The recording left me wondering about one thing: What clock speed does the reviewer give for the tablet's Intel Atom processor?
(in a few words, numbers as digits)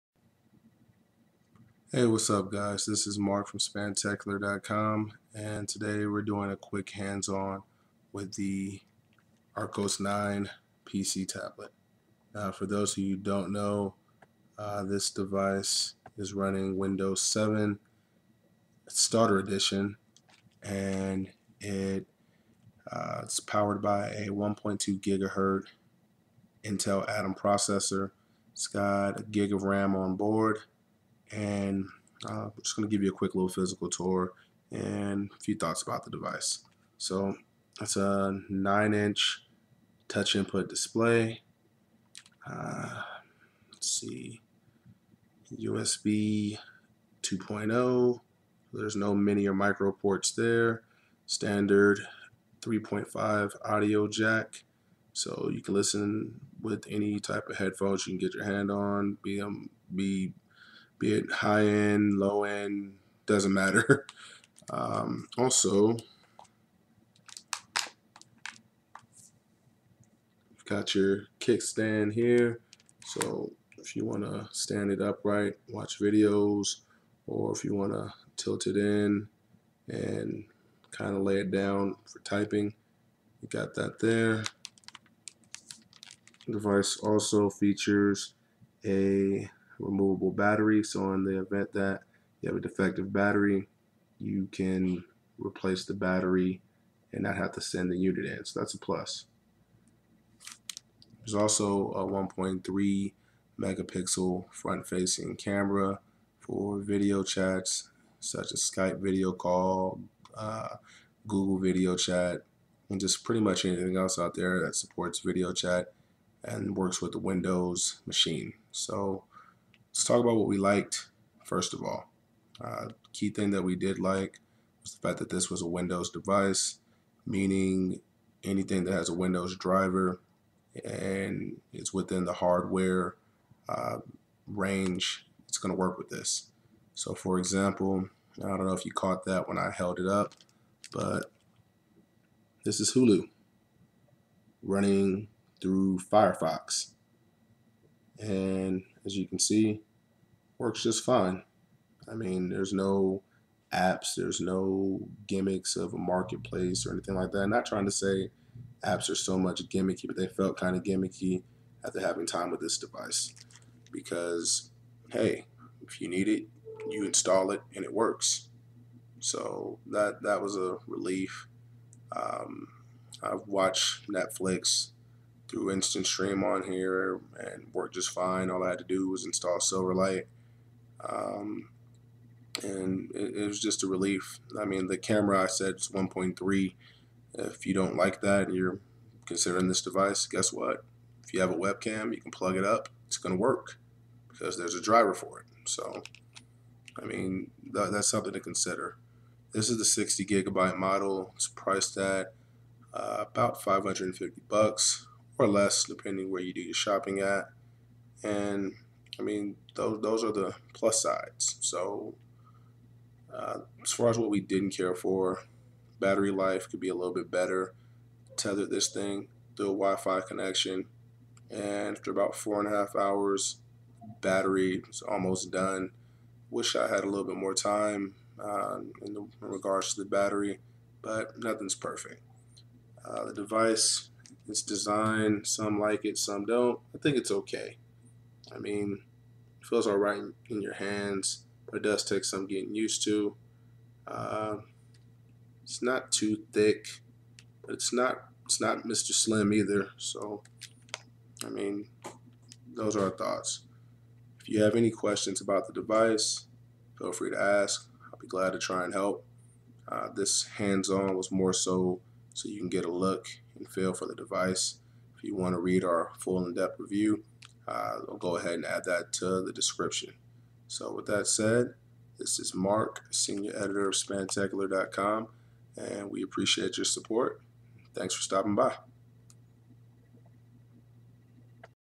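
1.2 GHz.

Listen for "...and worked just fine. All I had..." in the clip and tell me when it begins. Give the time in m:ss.
2:57.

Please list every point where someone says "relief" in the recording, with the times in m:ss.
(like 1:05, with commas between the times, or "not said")
2:50, 3:03.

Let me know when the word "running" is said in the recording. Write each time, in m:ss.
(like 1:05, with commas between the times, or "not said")
0:16, 2:24.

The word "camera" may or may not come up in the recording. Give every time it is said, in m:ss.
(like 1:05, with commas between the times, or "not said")
1:45, 3:04.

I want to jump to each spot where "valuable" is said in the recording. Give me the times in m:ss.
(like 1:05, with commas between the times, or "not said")
not said.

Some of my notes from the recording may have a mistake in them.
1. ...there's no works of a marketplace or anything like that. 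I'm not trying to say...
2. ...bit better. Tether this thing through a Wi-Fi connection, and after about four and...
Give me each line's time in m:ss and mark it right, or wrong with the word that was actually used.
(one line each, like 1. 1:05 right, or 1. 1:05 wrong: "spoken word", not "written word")
1. 2:34 wrong: "gimmicks", not "works"
2. 3:37 right.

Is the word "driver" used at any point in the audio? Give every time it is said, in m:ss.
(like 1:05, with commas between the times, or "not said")
2:09, 3:14.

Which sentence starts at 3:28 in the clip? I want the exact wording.
And I mean, those those are the plus sides.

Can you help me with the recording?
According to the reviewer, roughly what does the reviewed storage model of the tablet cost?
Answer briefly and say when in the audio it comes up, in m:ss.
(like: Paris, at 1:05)
$550, at 3:23.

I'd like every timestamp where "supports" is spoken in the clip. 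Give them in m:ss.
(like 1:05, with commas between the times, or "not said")
1:54, 4:36.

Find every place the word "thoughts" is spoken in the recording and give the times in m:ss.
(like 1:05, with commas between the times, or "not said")
0:35, 4:13.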